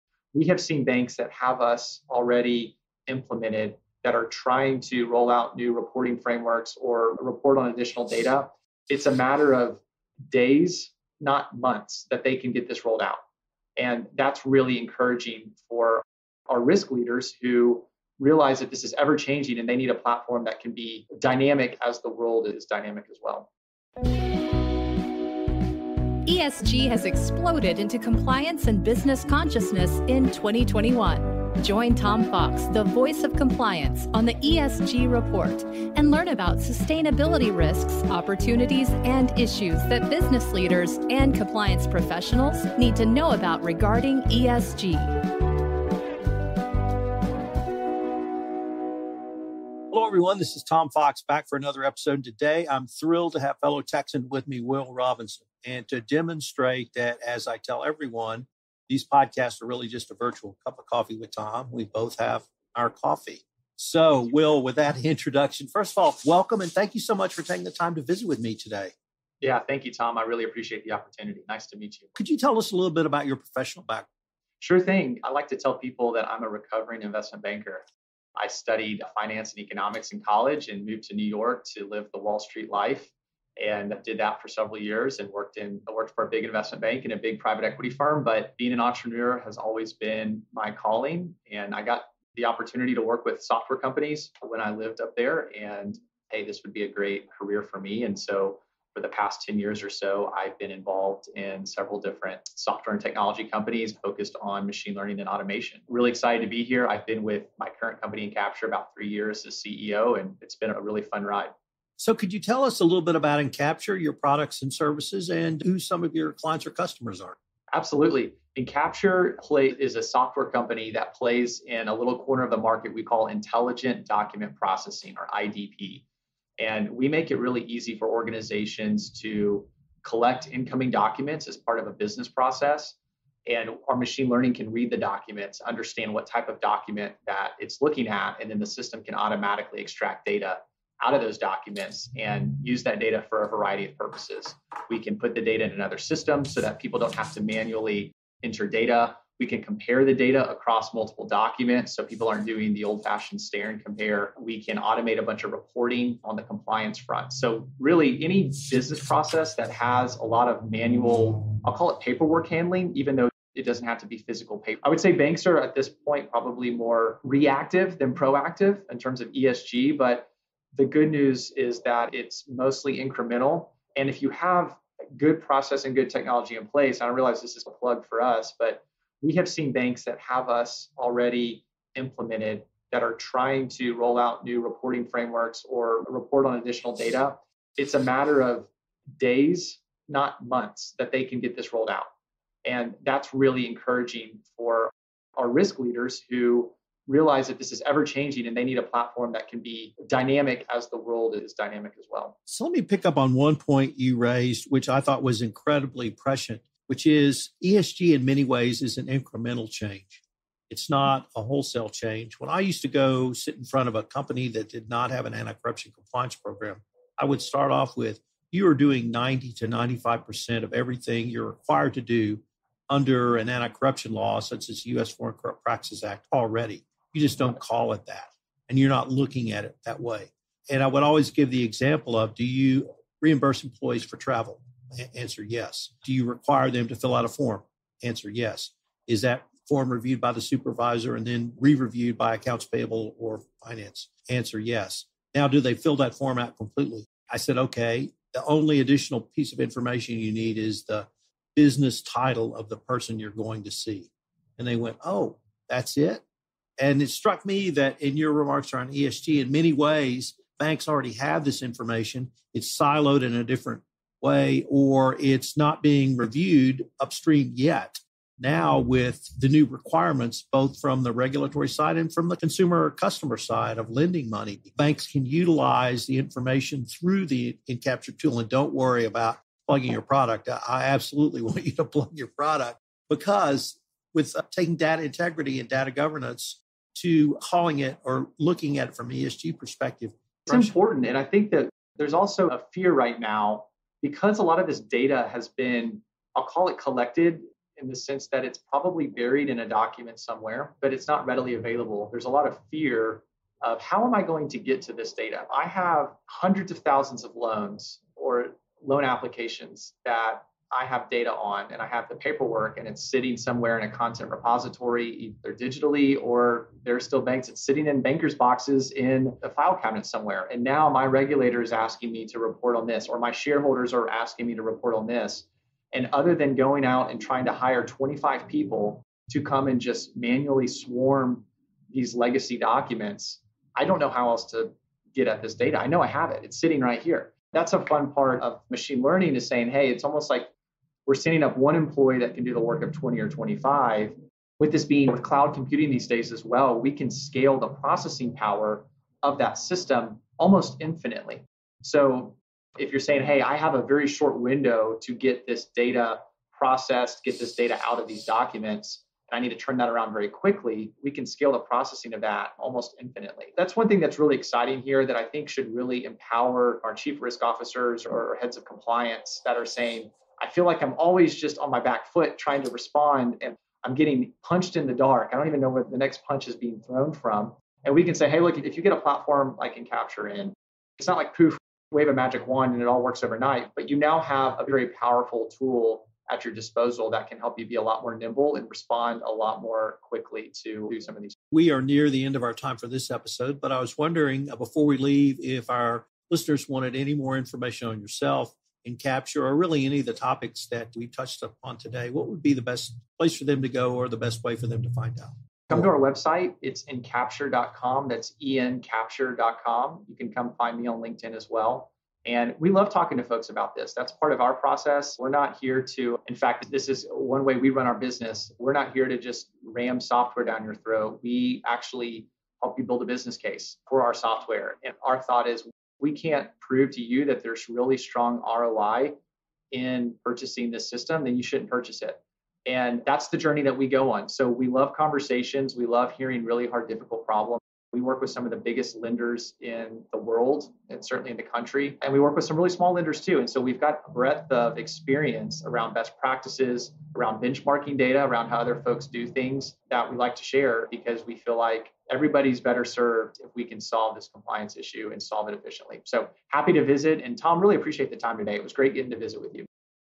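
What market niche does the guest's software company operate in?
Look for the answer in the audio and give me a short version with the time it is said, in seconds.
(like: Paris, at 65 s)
intelligent document processing, at 123 s.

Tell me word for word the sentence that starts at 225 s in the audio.
Foreign Corrupt Practices Act, already you just don't call it that.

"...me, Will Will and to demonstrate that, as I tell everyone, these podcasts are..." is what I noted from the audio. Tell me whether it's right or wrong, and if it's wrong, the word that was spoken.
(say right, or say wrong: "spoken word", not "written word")
wrong: "Robinson", not "Will".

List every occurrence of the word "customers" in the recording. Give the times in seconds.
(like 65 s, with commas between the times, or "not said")
116 s, 272 s.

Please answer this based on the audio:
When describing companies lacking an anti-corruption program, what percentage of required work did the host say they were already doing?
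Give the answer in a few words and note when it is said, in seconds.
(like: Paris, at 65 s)
90 to 95%, at 219 s.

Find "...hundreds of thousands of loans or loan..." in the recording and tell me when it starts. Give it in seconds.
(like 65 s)
306 s.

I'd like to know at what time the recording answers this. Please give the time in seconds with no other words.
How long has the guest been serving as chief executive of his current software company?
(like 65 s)
108 s.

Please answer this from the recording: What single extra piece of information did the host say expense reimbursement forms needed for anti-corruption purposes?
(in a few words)
business title.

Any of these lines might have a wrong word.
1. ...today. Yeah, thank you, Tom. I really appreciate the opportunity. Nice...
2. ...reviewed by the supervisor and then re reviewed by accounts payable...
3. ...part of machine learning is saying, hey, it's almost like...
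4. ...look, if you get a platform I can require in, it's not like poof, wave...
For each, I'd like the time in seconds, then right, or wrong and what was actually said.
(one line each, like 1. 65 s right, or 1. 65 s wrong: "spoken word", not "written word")
1. 68 s right
2. 239 s right
3. 338 s right
4. 378 s wrong: "capture", not "require".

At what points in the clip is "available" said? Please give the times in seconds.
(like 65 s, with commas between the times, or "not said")
301 s.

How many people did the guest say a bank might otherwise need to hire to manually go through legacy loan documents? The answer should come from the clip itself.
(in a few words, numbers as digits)
25.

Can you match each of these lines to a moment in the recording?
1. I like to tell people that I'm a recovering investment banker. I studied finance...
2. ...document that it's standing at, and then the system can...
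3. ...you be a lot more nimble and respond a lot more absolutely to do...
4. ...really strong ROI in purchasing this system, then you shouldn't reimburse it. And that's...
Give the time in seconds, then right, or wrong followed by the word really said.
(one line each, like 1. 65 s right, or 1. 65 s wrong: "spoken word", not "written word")
1. 75 s right
2. 136 s wrong: "looking", not "standing"
3. 387 s wrong: "quickly", not "absolutely"
4. 427 s wrong: "purchase", not "reimburse".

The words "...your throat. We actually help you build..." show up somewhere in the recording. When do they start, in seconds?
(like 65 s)
420 s.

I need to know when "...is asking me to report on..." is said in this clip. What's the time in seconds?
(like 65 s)
321 s.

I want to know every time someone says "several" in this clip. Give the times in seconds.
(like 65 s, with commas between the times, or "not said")
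84 s, 101 s.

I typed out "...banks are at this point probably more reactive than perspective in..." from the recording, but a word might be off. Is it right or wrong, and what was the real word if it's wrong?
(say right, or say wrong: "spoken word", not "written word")
wrong: "proactive", not "perspective".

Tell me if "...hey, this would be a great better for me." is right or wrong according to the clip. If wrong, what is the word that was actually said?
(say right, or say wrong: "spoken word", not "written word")
wrong: "career", not "better".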